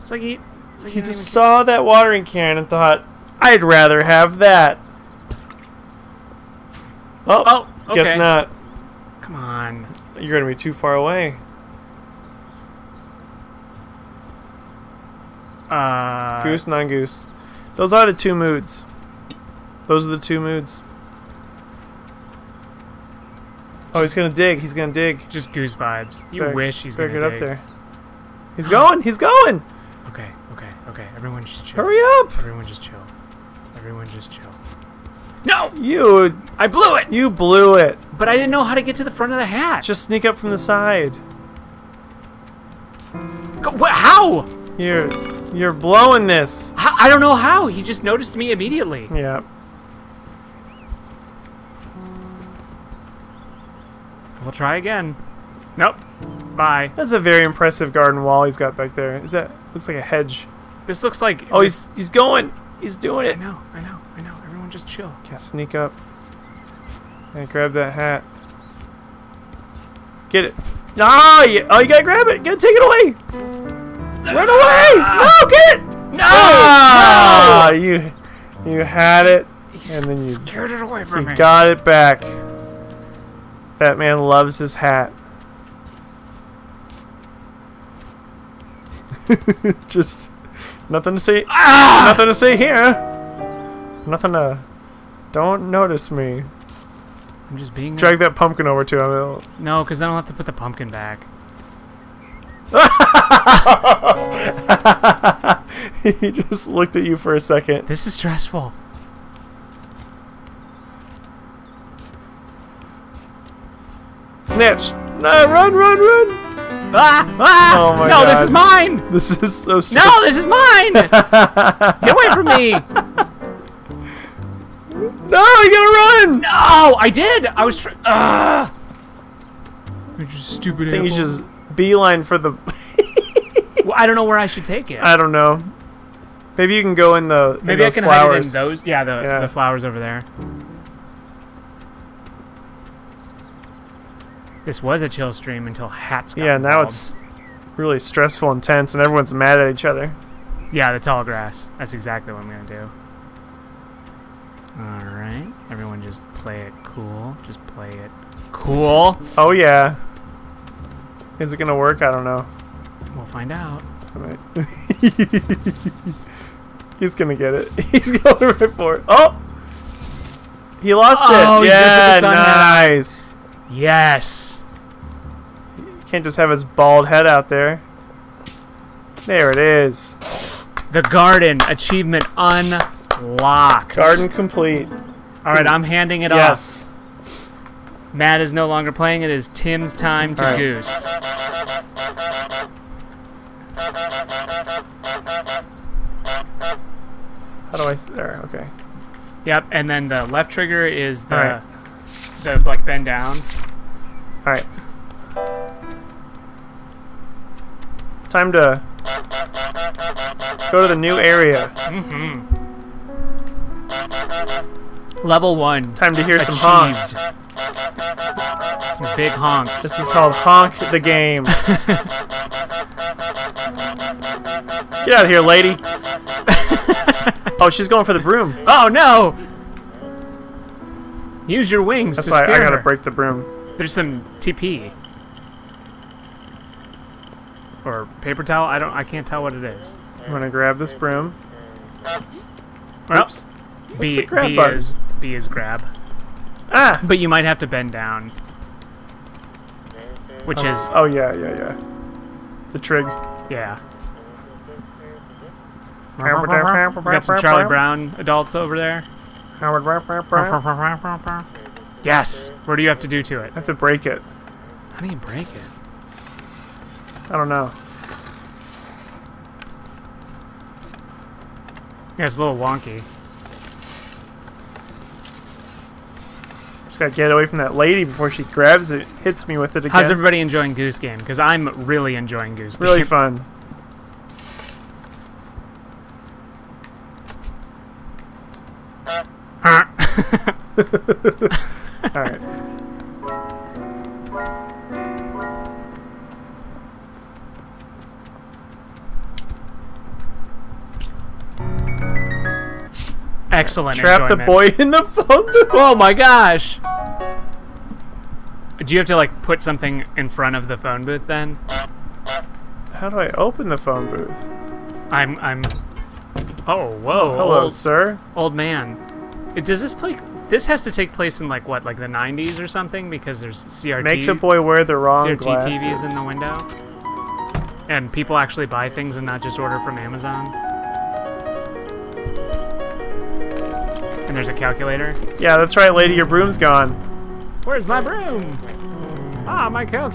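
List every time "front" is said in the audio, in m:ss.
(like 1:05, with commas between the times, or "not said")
0:39, 5:10.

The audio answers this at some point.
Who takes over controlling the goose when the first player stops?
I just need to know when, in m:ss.
3:09.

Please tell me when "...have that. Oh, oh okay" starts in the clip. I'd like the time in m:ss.
0:04.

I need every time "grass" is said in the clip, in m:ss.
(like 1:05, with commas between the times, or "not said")
2:31.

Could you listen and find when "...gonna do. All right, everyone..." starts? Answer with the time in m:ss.
2:32.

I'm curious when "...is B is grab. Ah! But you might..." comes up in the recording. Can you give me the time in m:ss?
4:04.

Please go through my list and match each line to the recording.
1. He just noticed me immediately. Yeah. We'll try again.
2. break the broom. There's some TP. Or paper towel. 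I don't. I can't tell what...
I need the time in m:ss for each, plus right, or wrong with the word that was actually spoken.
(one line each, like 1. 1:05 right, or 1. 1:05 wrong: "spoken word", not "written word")
1. 0:47 right
2. 3:52 right.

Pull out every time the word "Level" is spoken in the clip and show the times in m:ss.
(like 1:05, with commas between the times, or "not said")
3:35.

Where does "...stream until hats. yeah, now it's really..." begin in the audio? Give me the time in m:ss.
2:25.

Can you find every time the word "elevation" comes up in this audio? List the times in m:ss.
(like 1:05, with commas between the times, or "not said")
not said.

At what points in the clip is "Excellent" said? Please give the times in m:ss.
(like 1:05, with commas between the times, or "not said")
5:03.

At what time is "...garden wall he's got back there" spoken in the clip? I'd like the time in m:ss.
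0:57.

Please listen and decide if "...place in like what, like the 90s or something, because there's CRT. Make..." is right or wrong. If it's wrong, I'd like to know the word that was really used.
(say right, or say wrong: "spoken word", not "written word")
right.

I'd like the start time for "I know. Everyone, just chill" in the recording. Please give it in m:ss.
1:04.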